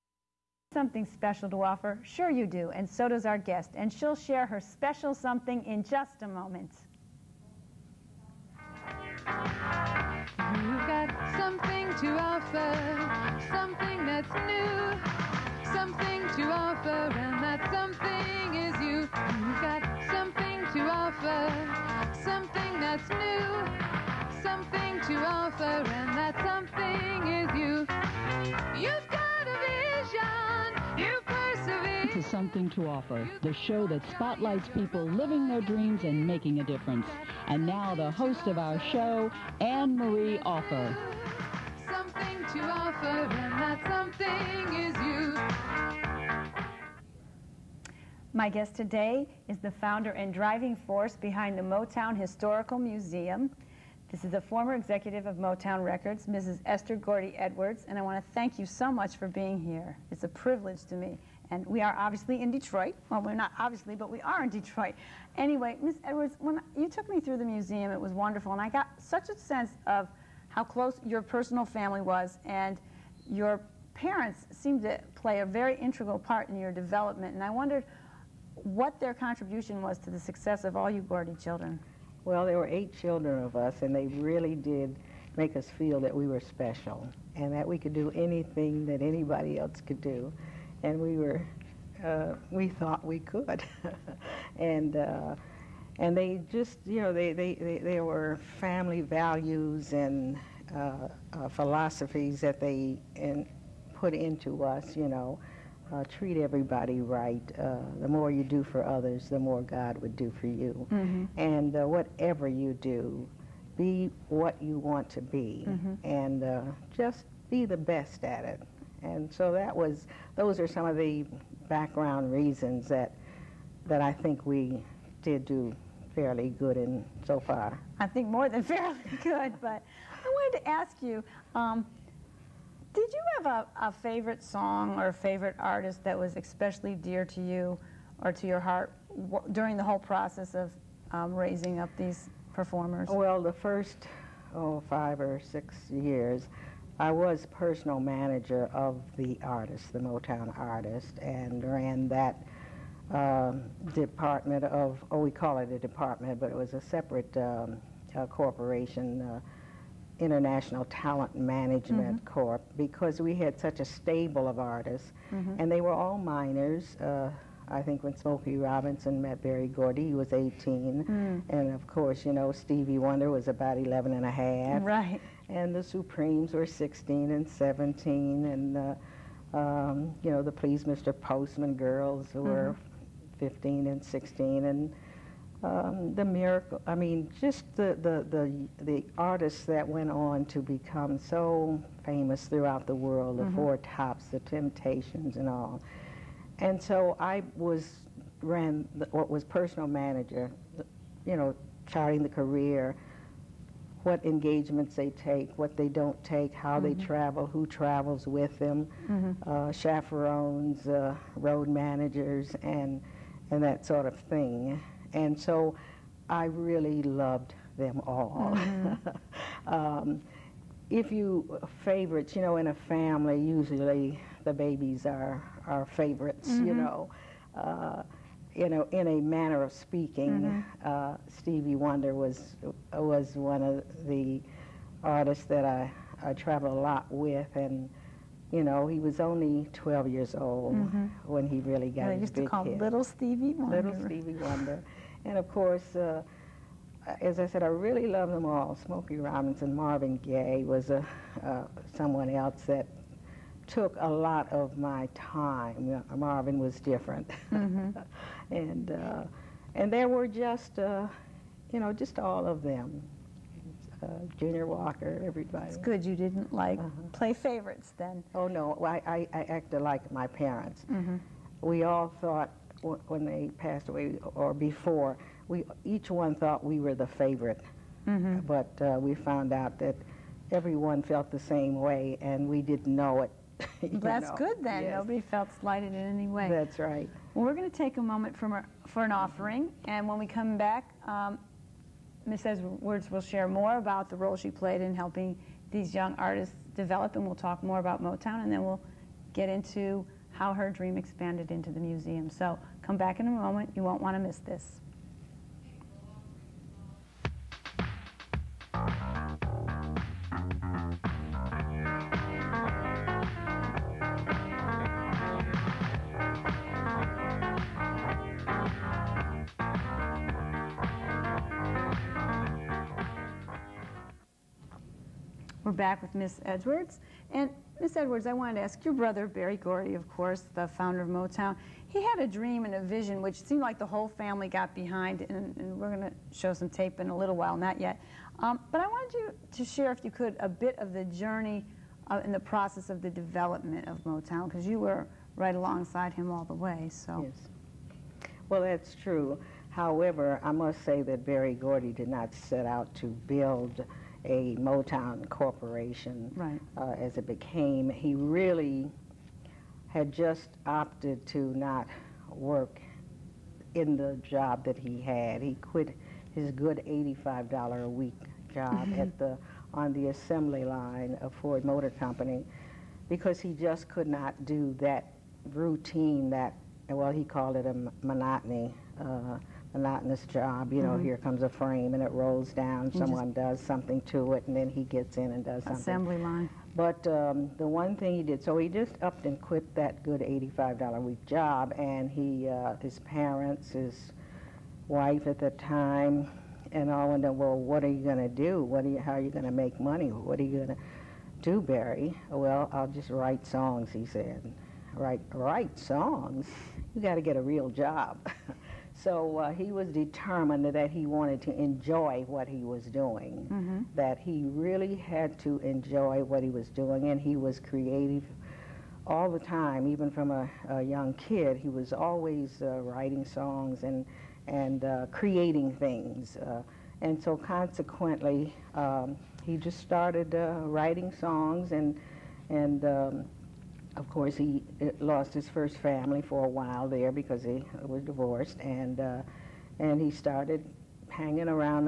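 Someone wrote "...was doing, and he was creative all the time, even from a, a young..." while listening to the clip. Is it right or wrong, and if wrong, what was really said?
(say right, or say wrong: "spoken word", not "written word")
right.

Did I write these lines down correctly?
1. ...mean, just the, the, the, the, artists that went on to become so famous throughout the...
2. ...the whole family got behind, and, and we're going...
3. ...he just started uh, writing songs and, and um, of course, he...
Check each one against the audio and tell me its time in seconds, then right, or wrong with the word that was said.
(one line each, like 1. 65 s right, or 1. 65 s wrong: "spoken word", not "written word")
1. 186 s right
2. 333 s right
3. 429 s right.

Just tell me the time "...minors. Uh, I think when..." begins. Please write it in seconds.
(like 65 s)
166 s.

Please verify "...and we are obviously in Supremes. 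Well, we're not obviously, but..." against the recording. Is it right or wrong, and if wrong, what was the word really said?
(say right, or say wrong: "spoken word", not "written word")
wrong: "Detroit", not "Supremes".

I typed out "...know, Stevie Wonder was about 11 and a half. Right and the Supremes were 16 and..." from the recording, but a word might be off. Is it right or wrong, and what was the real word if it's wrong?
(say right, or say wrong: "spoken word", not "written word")
right.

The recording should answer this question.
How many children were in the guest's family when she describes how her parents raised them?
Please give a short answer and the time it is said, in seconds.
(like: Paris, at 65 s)
8, at 82 s.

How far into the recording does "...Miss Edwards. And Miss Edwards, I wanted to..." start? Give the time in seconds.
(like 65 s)
326 s.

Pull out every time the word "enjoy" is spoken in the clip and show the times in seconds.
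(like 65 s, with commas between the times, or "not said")
411 s, 415 s.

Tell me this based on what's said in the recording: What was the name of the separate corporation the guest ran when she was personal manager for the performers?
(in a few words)
International Talent Management.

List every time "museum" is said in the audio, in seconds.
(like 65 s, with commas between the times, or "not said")
52 s, 67 s, 301 s.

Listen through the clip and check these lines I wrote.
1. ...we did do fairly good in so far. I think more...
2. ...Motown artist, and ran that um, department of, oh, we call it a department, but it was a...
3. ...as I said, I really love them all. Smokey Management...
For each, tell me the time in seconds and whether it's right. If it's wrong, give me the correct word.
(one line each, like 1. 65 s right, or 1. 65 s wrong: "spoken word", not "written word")
1. 124 s right
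2. 149 s right
3. 247 s wrong: "Robinson", not "Management".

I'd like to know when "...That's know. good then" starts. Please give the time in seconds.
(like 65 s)
283 s.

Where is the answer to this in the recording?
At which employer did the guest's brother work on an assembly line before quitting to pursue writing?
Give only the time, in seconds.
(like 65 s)
371 s.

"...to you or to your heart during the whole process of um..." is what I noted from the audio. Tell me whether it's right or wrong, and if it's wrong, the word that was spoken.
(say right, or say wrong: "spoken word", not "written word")
right.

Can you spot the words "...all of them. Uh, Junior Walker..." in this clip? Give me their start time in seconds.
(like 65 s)
262 s.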